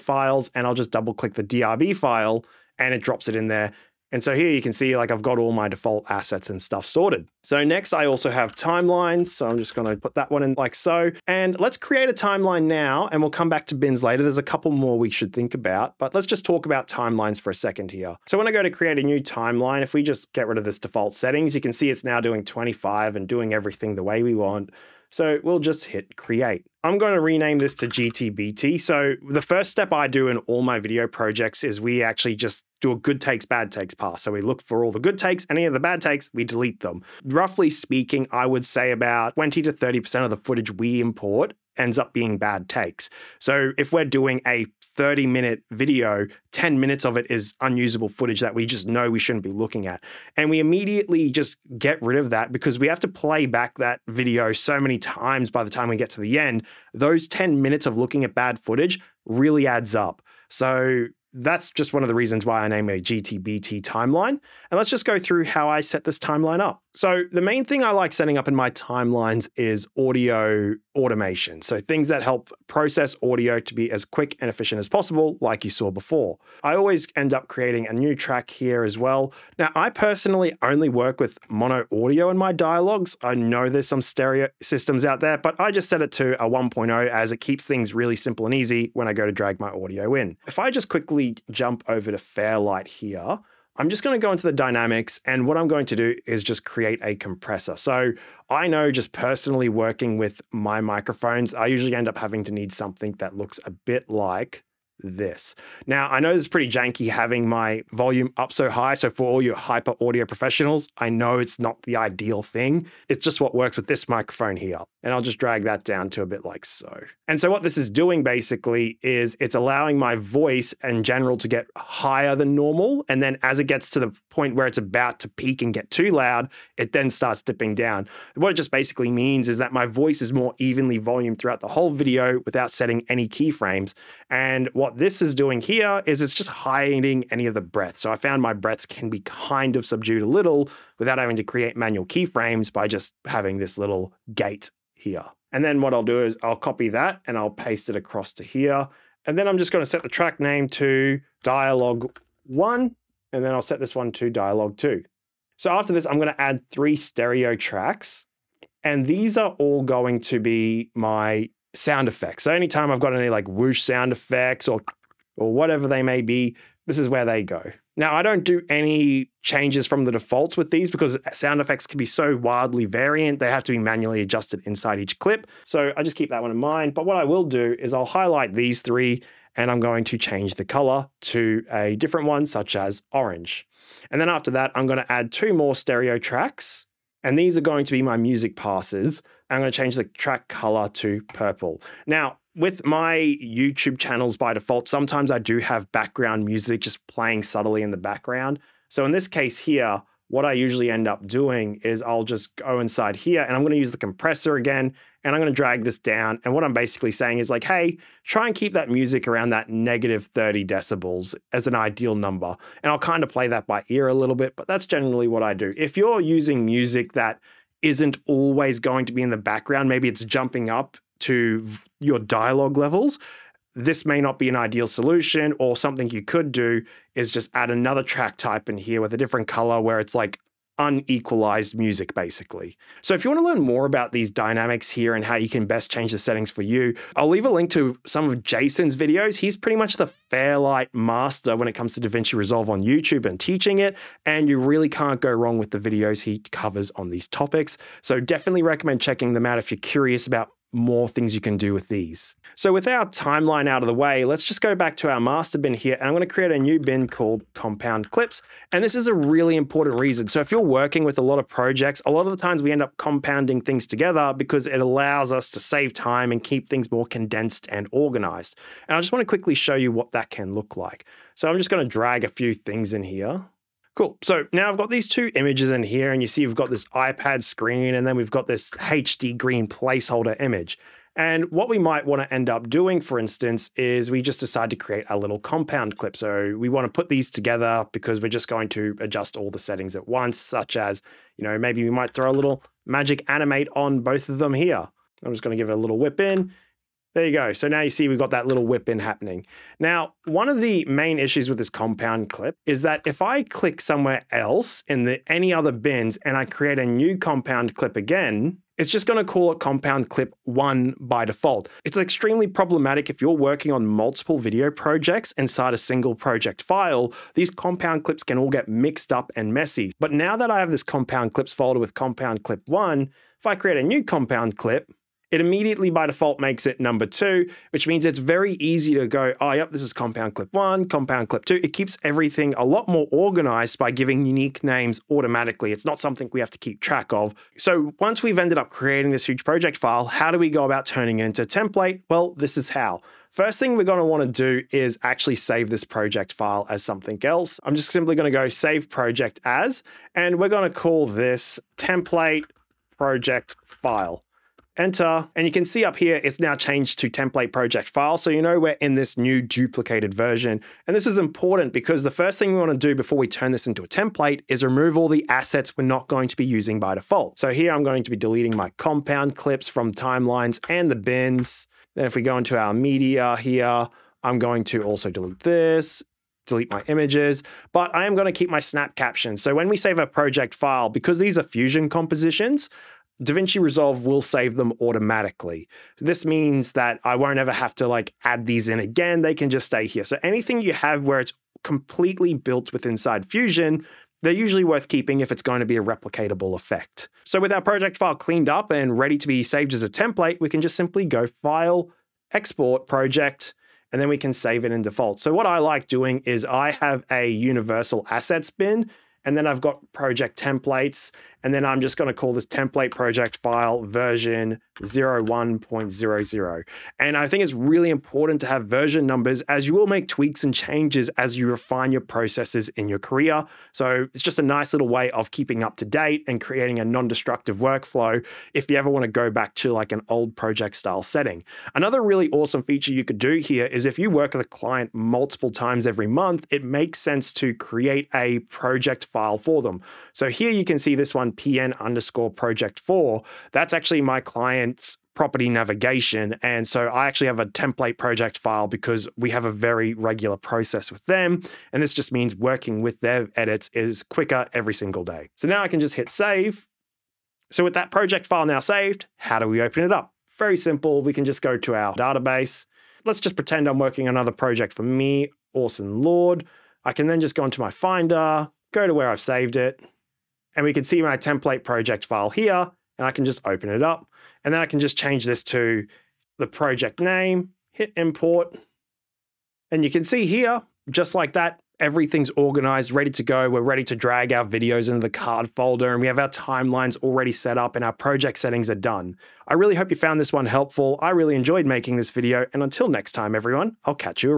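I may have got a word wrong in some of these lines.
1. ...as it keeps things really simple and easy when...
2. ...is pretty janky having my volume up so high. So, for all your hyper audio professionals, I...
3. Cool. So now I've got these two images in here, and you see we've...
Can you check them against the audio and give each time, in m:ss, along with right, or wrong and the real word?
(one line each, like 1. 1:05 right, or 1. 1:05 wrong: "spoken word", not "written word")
1. 1:27 right
2. 1:46 right
3. 4:33 right.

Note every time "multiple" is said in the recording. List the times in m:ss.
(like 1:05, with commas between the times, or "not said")
5:13, 7:14.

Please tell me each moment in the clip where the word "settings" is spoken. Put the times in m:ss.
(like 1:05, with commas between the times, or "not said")
0:21, 1:08, 2:12, 3:56, 4:49, 7:11, 8:08.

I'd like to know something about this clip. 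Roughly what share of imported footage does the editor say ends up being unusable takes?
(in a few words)
20 to 30%.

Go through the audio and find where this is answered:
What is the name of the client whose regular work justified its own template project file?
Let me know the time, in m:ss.
7:25.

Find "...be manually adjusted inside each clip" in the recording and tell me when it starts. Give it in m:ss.
2:53.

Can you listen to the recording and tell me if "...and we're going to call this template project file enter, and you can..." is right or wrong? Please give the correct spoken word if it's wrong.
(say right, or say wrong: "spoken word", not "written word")
right.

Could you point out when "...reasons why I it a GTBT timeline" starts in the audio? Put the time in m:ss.
1:02.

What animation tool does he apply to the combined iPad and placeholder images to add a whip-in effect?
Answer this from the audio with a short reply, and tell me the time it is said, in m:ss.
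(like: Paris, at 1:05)
Magic animate, at 4:52.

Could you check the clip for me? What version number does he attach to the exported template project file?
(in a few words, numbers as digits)
01.00.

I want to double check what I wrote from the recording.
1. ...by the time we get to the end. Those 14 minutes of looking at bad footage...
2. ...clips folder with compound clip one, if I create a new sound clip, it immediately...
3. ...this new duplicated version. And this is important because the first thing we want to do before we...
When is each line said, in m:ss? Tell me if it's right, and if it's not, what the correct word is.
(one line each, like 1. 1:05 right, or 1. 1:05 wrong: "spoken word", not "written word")
1. 0:55 wrong: "10", not "14"
2. 5:21 wrong: "compound", not "sound"
3. 5:58 right.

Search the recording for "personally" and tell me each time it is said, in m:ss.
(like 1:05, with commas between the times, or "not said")
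1:19, 1:39.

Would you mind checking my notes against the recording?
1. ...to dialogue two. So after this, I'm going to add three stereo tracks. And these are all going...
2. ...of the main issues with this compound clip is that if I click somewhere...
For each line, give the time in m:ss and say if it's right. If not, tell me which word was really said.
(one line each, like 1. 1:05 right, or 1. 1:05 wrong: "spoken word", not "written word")
1. 2:34 right
2. 5:00 right.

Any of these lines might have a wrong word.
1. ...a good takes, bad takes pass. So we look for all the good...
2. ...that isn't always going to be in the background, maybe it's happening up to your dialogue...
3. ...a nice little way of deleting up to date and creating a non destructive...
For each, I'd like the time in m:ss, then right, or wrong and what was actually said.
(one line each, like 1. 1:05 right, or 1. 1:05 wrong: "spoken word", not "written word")
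1. 0:32 right
2. 3:37 wrong: "jumping", not "happening"
3. 7:04 wrong: "keeping", not "deleting".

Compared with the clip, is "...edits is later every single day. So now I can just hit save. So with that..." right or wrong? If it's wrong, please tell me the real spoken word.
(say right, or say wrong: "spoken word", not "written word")
wrong: "quicker", not "later".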